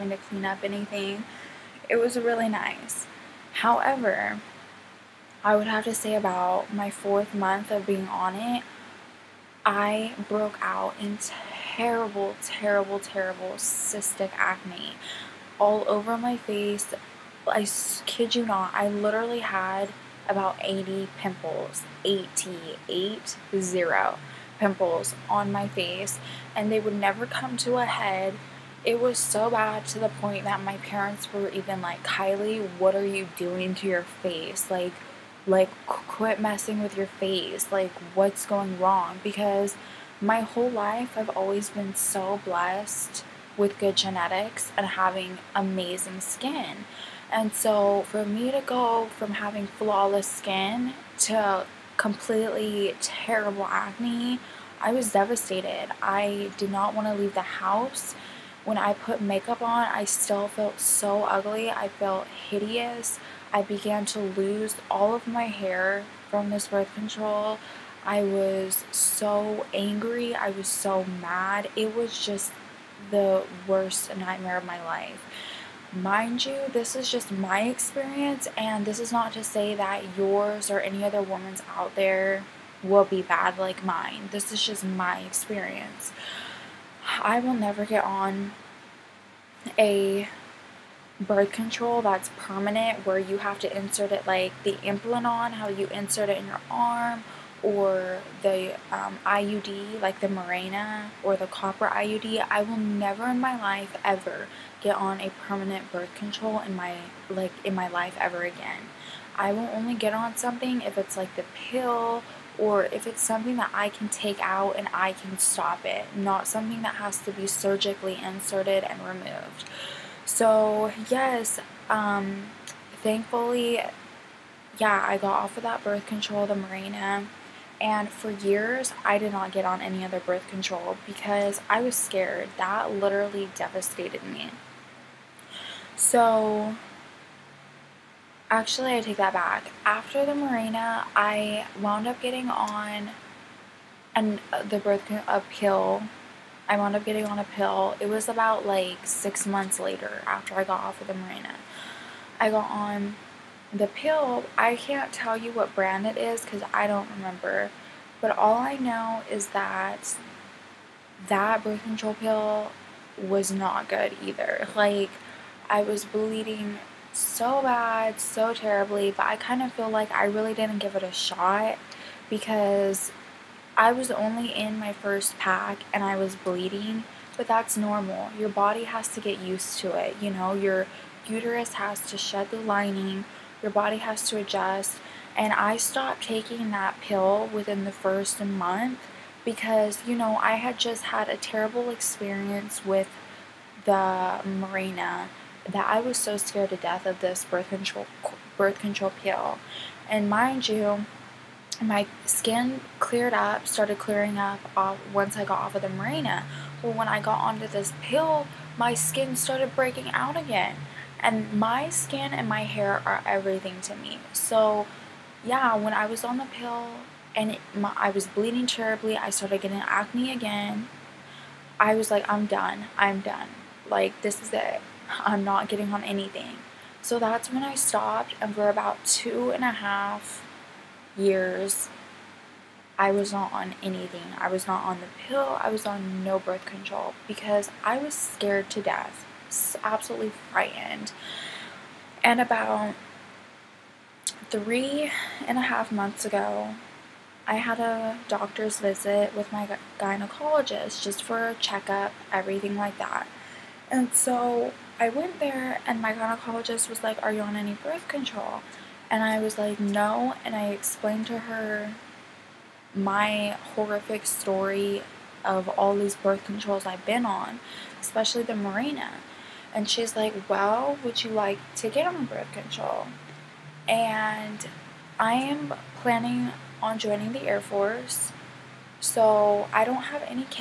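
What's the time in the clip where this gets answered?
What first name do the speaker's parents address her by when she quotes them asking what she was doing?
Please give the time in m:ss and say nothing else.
0:32.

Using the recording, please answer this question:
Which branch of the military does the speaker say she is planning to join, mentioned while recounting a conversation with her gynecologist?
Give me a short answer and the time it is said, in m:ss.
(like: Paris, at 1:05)
Air Force, at 4:37.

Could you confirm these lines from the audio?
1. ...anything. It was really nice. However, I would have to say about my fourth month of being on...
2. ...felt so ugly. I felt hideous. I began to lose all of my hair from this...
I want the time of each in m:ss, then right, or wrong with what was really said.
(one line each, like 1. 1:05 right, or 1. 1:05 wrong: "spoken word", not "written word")
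1. 0:00 right
2. 1:00 right.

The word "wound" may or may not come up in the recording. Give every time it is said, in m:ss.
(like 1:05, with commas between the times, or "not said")
2:21, 2:26.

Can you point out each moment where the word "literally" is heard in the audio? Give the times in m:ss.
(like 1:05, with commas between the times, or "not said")
0:18, 2:12.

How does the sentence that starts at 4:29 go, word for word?
And she's like, well, would you like to get on birth control?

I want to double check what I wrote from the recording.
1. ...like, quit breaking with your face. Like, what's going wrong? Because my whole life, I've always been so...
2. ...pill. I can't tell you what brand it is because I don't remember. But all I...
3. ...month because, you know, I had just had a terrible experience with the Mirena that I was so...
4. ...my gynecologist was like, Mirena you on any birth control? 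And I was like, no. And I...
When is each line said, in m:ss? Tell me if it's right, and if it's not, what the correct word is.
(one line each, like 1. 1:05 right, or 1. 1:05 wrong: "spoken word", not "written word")
1. 0:35 wrong: "messing", not "breaking"
2. 2:33 right
3. 3:08 right
4. 4:16 wrong: "Are", not "Mirena".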